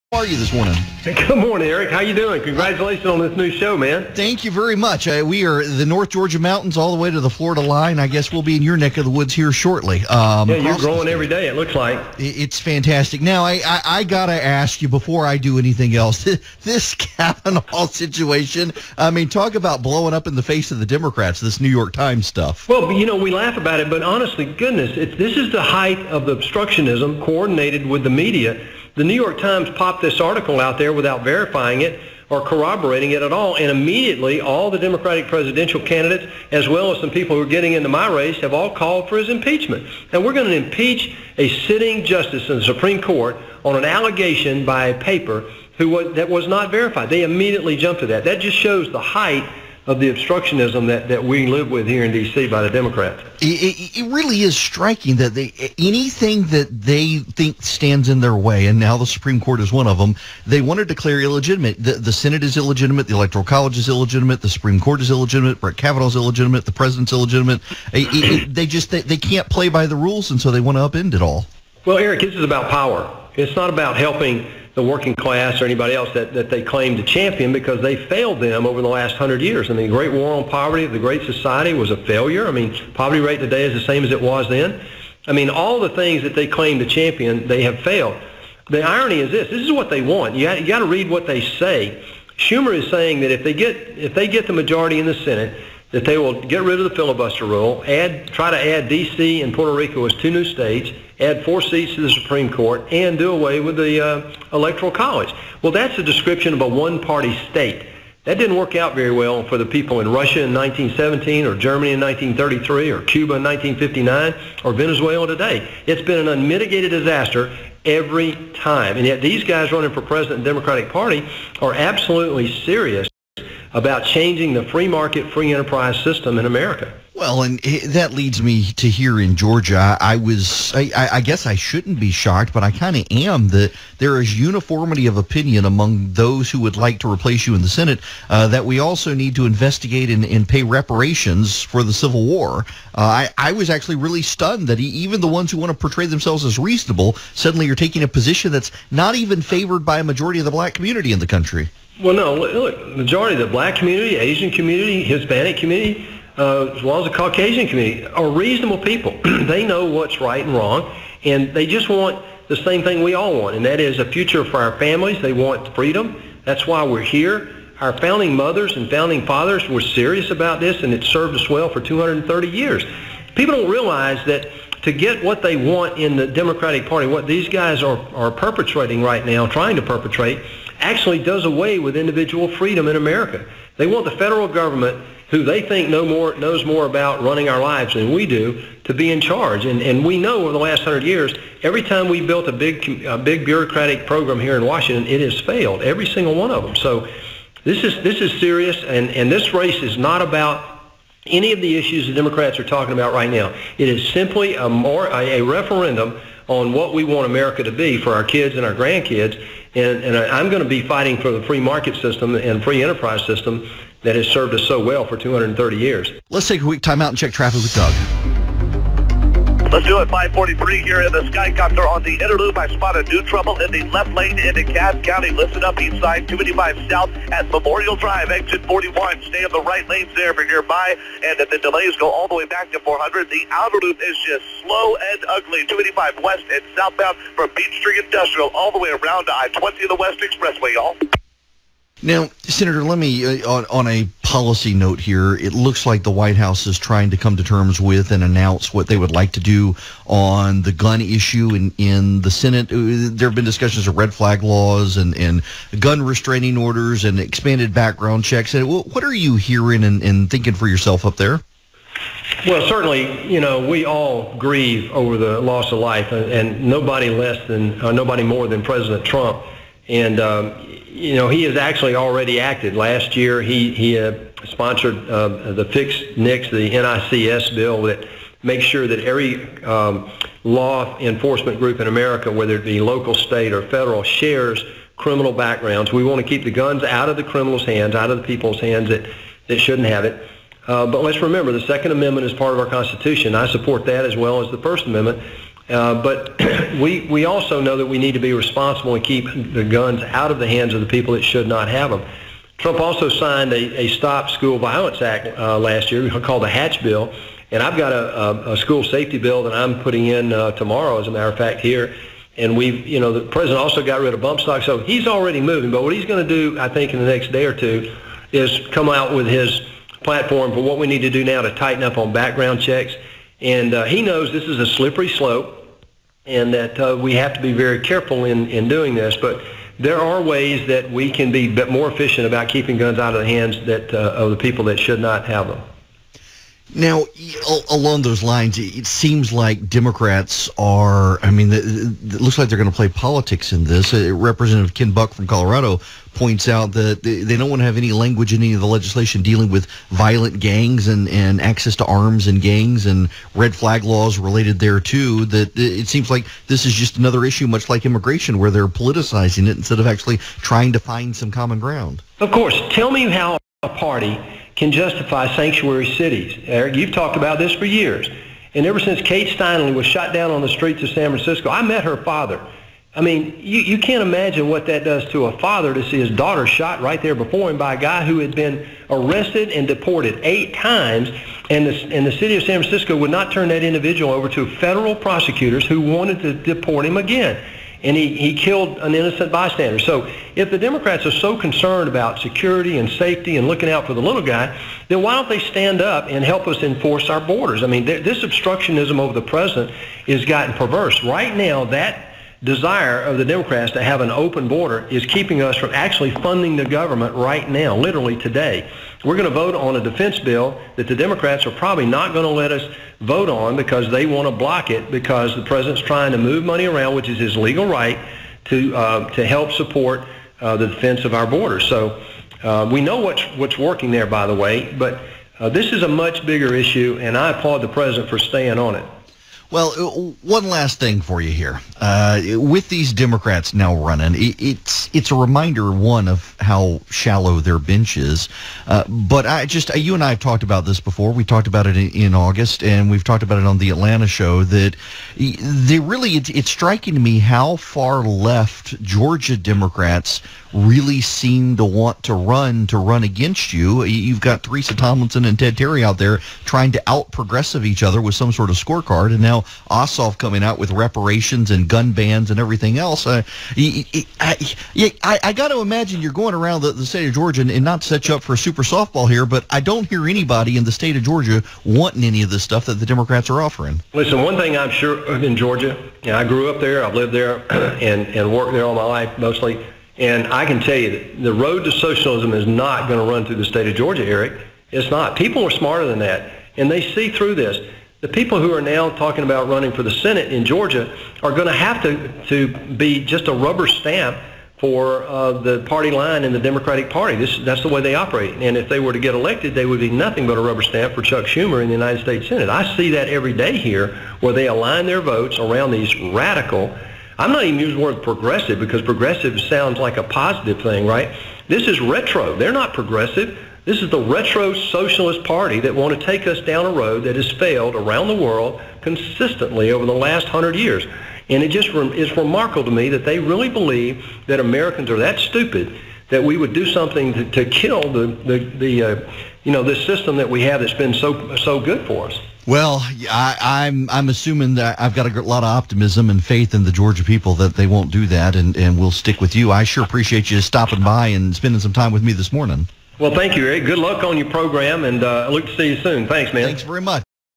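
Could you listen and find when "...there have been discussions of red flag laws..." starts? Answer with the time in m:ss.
4:13.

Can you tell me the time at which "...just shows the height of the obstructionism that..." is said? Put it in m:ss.
0:48.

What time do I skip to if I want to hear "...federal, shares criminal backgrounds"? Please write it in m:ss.
4:43.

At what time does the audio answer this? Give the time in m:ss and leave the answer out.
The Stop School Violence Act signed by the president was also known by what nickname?
5:06.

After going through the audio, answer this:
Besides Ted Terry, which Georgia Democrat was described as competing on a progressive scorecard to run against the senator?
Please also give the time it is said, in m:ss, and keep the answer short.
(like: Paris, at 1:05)
Teresa Tomlinson, at 7:34.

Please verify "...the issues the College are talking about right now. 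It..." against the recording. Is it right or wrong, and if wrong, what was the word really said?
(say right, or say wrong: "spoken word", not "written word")
wrong: "Democrats", not "College".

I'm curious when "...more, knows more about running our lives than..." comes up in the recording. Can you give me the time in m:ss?
3:06.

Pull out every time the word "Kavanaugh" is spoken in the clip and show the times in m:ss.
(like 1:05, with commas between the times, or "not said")
0:16, 1:05.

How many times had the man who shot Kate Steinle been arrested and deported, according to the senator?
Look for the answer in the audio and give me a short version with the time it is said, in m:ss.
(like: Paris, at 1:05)
8, at 6:20.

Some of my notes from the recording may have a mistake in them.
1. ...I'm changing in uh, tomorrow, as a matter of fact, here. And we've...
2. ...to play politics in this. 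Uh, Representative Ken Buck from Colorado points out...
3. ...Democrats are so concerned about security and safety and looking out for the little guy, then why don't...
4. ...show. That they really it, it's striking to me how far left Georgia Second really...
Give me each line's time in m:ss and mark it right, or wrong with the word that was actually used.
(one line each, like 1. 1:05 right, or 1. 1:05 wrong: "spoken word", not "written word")
1. 5:09 wrong: "putting", not "changing"
2. 5:42 right
3. 6:30 right
4. 7:24 wrong: "Democrats", not "Second".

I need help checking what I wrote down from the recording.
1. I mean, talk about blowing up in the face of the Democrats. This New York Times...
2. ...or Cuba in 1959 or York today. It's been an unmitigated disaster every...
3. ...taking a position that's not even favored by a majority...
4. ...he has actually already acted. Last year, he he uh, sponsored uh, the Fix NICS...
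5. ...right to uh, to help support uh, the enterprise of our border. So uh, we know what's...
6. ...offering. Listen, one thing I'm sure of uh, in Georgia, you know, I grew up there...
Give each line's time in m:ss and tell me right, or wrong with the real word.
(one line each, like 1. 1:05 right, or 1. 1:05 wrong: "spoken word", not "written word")
1. 0:18 right
2. 1:52 wrong: "Venezuela", not "York"
3. 2:27 right
4. 4:31 right
5. 6:57 wrong: "defense", not "enterprise"
6. 7:53 right.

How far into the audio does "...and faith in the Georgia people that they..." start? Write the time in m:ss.
8:56.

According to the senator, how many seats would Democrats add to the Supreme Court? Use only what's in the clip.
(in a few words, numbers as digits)
4.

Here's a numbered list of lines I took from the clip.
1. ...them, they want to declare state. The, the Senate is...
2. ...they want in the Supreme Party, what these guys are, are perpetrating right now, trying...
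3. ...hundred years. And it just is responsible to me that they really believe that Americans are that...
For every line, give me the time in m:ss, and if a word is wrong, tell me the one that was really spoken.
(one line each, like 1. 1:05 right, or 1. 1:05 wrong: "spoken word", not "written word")
1. 0:59 wrong: "illegitimate", not "state"
2. 2:55 wrong: "Democratic", not "Supreme"
3. 8:40 wrong: "remarkable", not "responsible".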